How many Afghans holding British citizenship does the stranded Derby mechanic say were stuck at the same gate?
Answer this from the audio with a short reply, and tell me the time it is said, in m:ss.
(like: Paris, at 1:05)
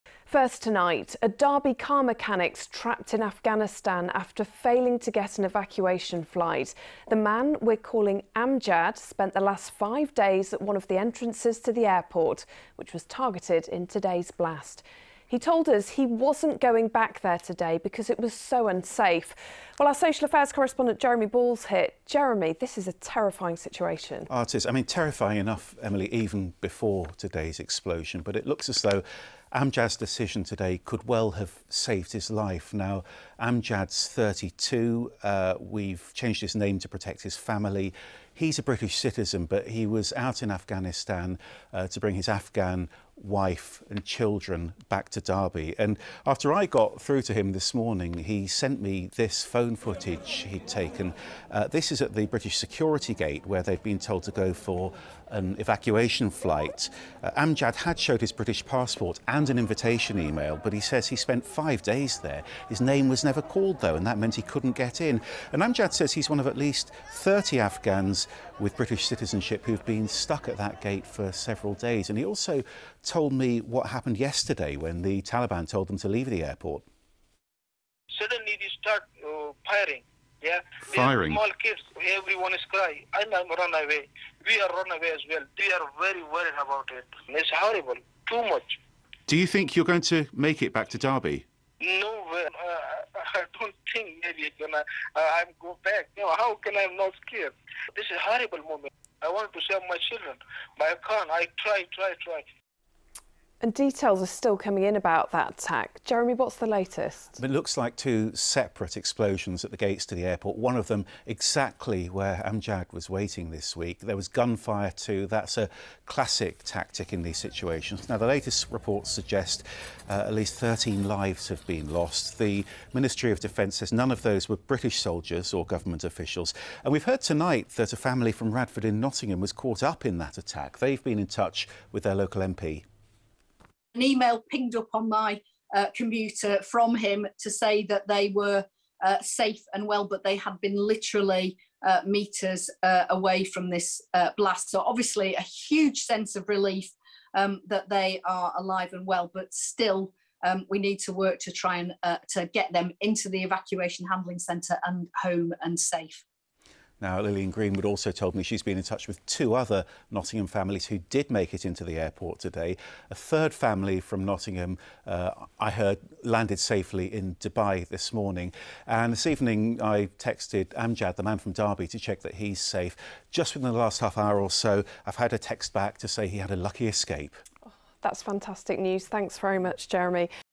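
30, at 1:07.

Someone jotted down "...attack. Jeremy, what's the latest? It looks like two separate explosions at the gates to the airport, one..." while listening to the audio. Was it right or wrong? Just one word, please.
right.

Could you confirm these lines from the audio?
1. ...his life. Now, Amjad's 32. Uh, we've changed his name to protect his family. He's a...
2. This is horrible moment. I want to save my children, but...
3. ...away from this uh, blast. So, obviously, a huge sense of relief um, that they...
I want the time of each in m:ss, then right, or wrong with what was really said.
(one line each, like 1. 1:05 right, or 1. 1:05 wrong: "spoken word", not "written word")
1. 0:32 right
2. 1:37 right
3. 2:23 right.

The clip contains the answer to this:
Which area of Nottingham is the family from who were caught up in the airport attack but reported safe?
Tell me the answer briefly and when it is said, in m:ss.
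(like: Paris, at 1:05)
Radford, at 2:08.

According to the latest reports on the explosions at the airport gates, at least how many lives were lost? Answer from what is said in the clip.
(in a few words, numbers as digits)
13.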